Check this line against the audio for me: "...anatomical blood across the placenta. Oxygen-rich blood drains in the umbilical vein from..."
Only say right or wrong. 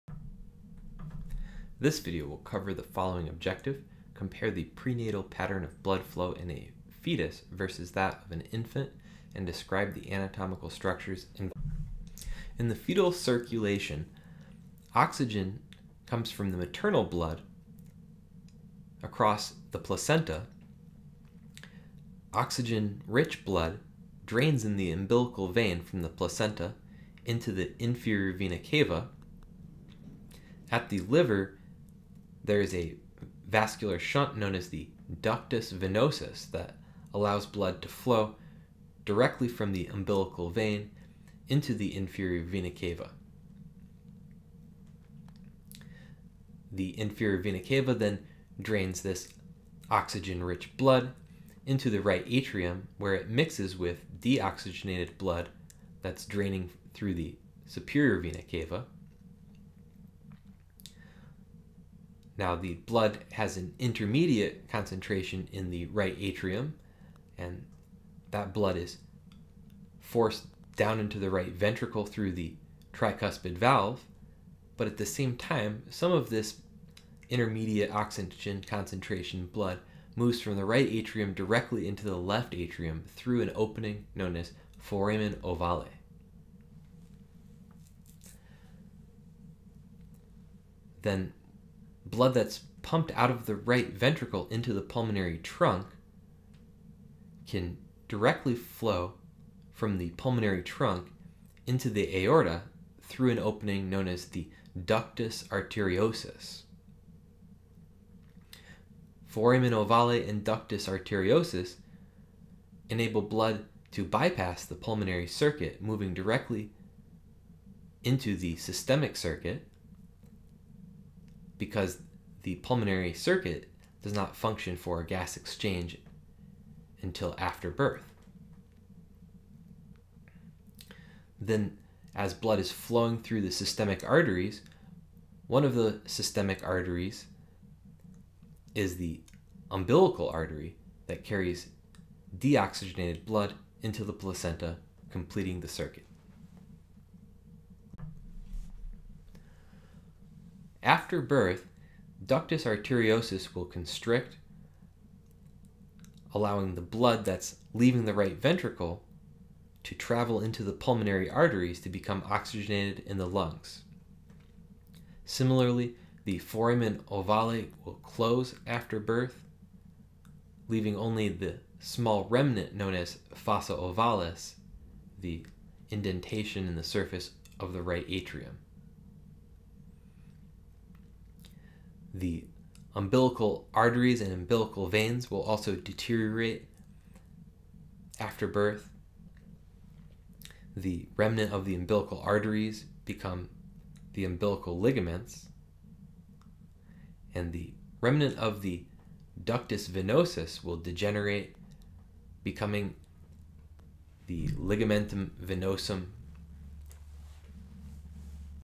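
wrong.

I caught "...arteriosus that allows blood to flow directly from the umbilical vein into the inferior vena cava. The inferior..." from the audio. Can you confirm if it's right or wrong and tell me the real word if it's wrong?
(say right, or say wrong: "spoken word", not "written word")
wrong: "venosus", not "arteriosus".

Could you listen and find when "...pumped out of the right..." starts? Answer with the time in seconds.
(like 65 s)
92 s.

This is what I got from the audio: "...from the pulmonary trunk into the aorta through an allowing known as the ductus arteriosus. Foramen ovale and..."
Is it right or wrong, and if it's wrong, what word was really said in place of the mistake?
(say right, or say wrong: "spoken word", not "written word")
wrong: "opening", not "allowing".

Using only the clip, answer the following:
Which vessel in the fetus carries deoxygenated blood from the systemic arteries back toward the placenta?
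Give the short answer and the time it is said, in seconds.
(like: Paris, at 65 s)
umbilical artery, at 139 s.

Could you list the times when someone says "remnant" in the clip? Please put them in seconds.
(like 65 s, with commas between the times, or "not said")
172 s, 191 s, 198 s.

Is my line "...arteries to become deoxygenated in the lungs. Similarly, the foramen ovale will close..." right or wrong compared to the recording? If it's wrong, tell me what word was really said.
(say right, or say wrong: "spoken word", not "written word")
wrong: "oxygenated", not "deoxygenated".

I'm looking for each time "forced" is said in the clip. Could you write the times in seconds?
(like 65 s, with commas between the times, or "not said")
69 s.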